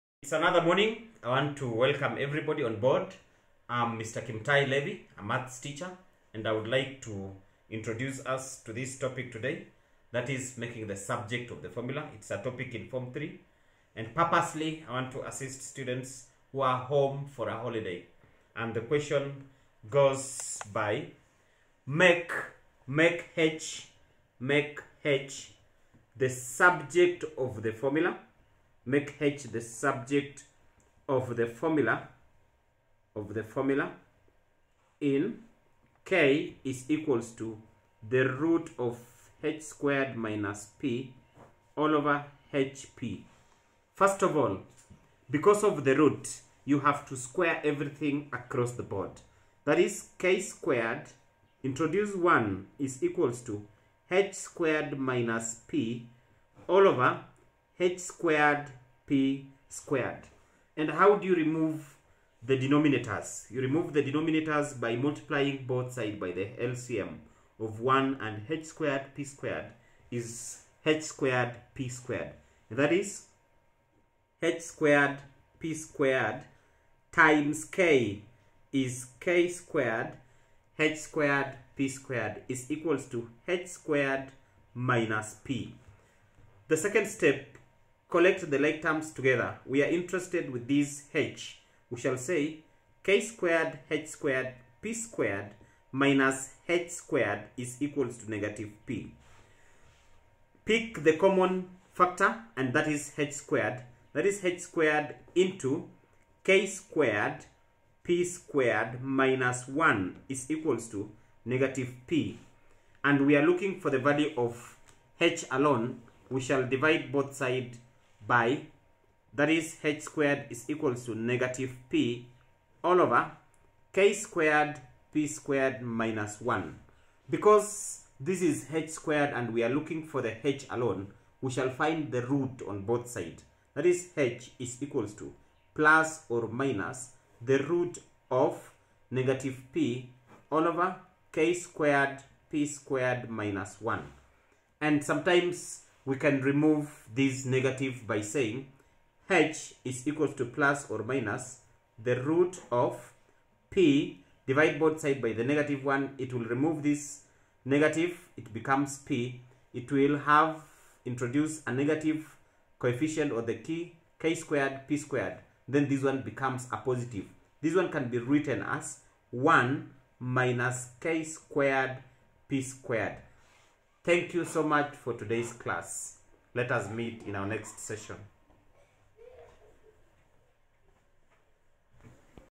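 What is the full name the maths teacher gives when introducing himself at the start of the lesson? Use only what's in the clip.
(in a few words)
Kimtai Levy.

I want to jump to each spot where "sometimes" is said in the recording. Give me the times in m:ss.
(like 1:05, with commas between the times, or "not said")
2:25.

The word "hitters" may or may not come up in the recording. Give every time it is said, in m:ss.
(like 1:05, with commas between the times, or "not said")
not said.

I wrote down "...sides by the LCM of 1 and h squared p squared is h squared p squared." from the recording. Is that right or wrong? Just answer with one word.
right.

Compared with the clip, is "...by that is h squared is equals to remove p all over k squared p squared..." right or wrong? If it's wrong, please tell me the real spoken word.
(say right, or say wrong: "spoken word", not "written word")
wrong: "negative", not "remove".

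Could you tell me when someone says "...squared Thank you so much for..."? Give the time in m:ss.
2:52.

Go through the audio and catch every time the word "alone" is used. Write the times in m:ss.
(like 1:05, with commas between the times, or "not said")
1:55, 2:10.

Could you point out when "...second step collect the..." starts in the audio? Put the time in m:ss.
1:26.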